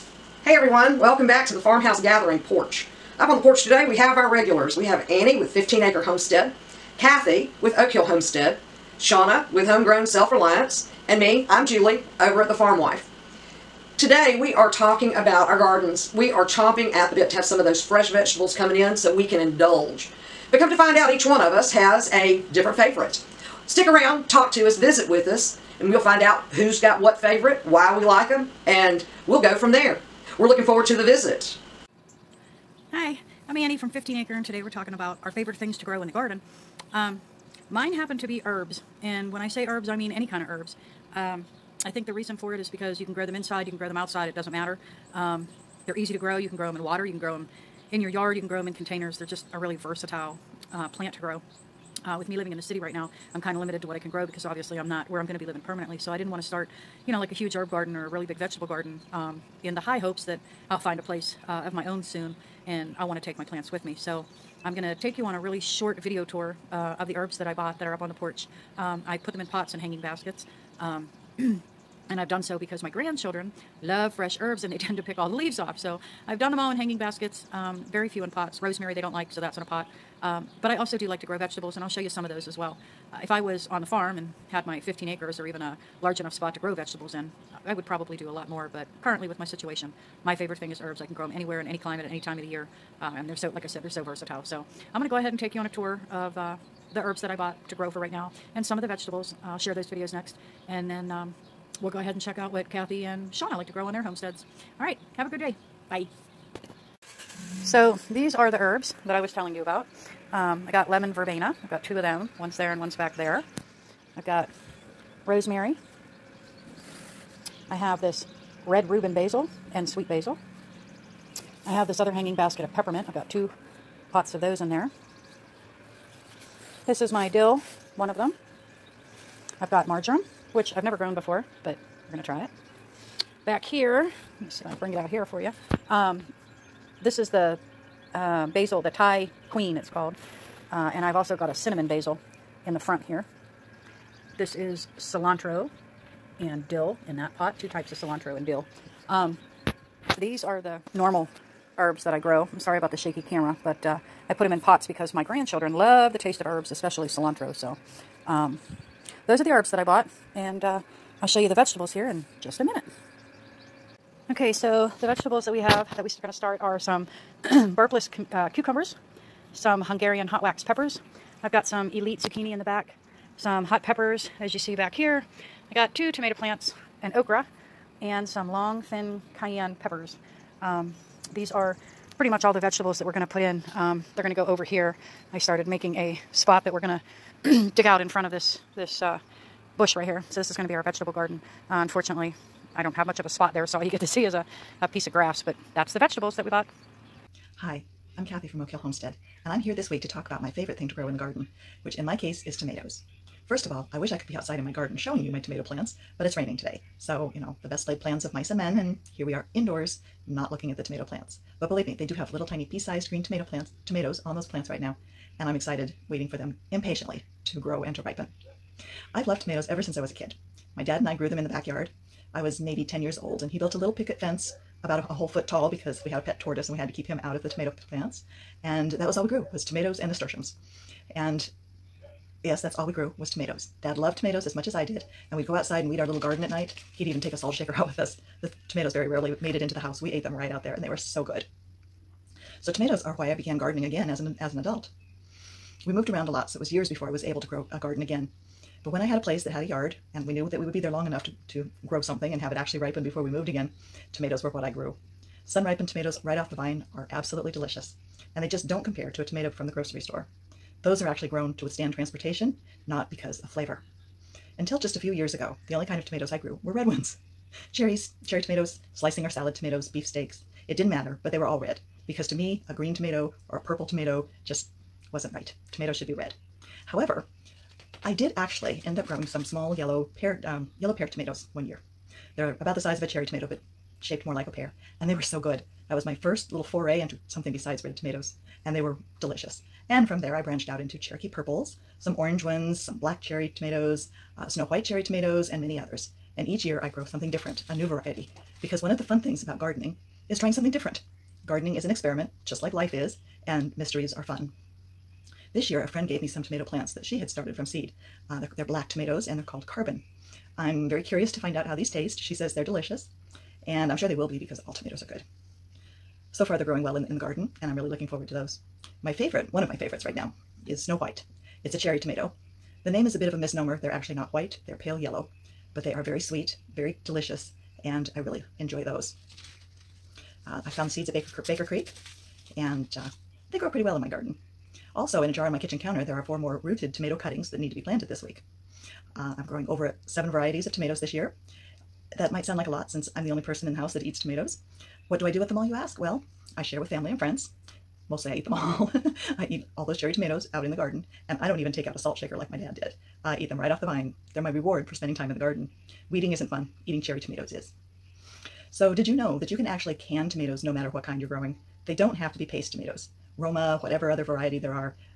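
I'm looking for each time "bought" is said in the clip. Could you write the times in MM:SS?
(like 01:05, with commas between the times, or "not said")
01:07, 01:37, 02:39, 03:16.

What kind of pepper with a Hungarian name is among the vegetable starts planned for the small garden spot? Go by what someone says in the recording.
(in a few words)
Hungarian hot wax.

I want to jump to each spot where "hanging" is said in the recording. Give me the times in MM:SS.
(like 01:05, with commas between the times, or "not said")
01:09, 01:16, 02:02.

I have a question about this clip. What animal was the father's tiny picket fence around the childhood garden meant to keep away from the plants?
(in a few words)
Pet tortoise.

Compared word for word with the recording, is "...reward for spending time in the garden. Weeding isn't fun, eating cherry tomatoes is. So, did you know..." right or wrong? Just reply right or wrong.
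right.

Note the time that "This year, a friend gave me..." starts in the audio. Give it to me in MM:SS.
05:05.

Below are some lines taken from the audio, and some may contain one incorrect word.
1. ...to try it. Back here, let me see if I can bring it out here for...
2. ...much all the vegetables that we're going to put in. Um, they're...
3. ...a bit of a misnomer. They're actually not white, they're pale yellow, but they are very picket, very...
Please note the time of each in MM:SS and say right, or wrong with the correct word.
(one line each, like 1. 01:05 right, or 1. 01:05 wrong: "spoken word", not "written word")
1. 02:12 right
2. 03:02 right
3. 05:23 wrong: "sweet", not "picket".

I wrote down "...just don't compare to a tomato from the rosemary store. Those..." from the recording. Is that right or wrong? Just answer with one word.
wrong.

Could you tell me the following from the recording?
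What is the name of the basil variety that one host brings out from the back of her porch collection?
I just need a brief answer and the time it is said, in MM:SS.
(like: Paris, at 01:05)
Thai queen, at 02:18.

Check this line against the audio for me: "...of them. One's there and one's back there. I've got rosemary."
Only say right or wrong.
right.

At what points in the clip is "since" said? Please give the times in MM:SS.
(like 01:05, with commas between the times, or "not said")
03:39, 05:42.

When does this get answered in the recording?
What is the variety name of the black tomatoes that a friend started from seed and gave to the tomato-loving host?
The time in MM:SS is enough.
05:09.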